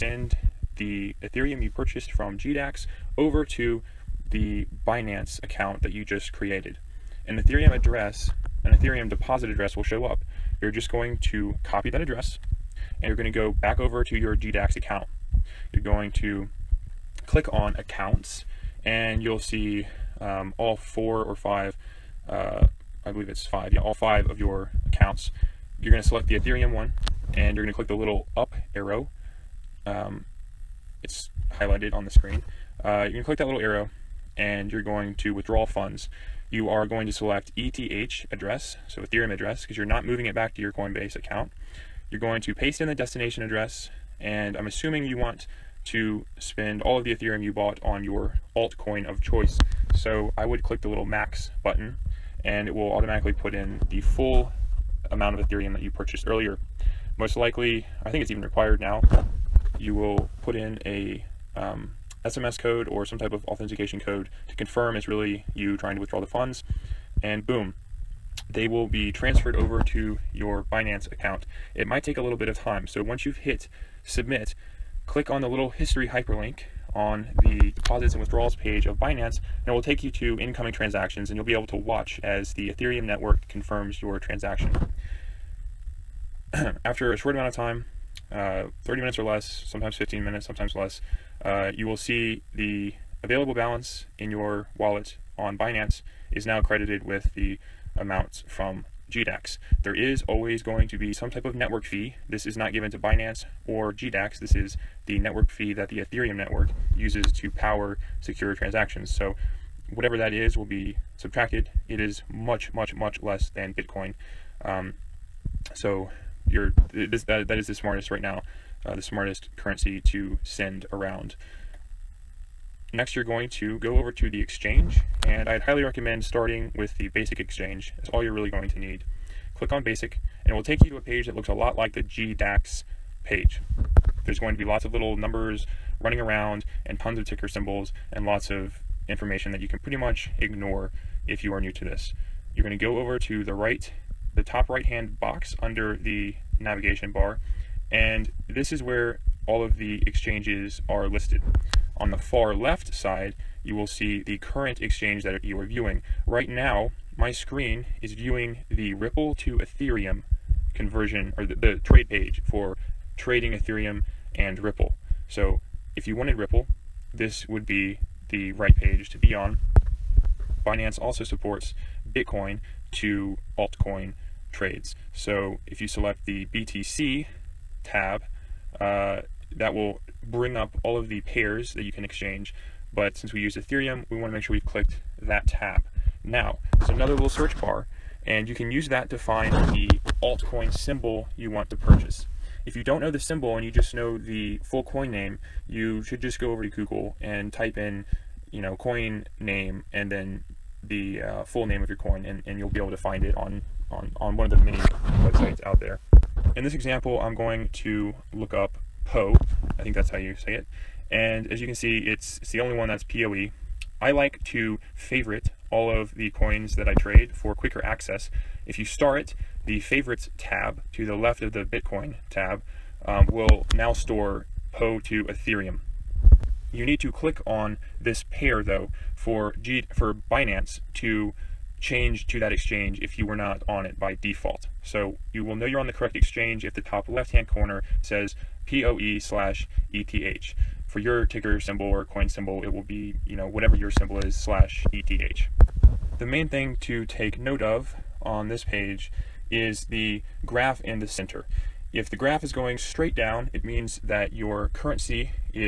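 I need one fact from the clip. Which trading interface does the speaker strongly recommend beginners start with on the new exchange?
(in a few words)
basic exchange.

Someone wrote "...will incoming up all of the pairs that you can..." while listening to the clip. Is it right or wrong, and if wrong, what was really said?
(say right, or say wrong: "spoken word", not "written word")
wrong: "bring", not "incoming".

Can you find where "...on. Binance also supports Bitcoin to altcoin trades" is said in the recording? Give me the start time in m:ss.
2:49.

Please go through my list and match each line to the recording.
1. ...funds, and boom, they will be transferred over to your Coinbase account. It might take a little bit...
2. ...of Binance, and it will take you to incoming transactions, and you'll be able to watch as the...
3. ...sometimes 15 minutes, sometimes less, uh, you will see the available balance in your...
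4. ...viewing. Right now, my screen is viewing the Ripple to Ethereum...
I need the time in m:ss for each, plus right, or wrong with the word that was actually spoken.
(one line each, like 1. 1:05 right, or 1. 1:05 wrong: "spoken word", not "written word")
1. 1:06 wrong: "Binance", not "Coinbase"
2. 1:18 right
3. 1:29 right
4. 2:35 right.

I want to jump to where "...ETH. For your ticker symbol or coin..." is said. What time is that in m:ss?
3:59.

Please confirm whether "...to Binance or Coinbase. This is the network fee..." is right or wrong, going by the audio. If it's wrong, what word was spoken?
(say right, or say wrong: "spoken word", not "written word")
wrong: "GDAX", not "Coinbase".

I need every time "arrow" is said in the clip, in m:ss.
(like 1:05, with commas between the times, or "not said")
0:28, 0:33.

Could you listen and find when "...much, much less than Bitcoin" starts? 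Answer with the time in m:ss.
1:52.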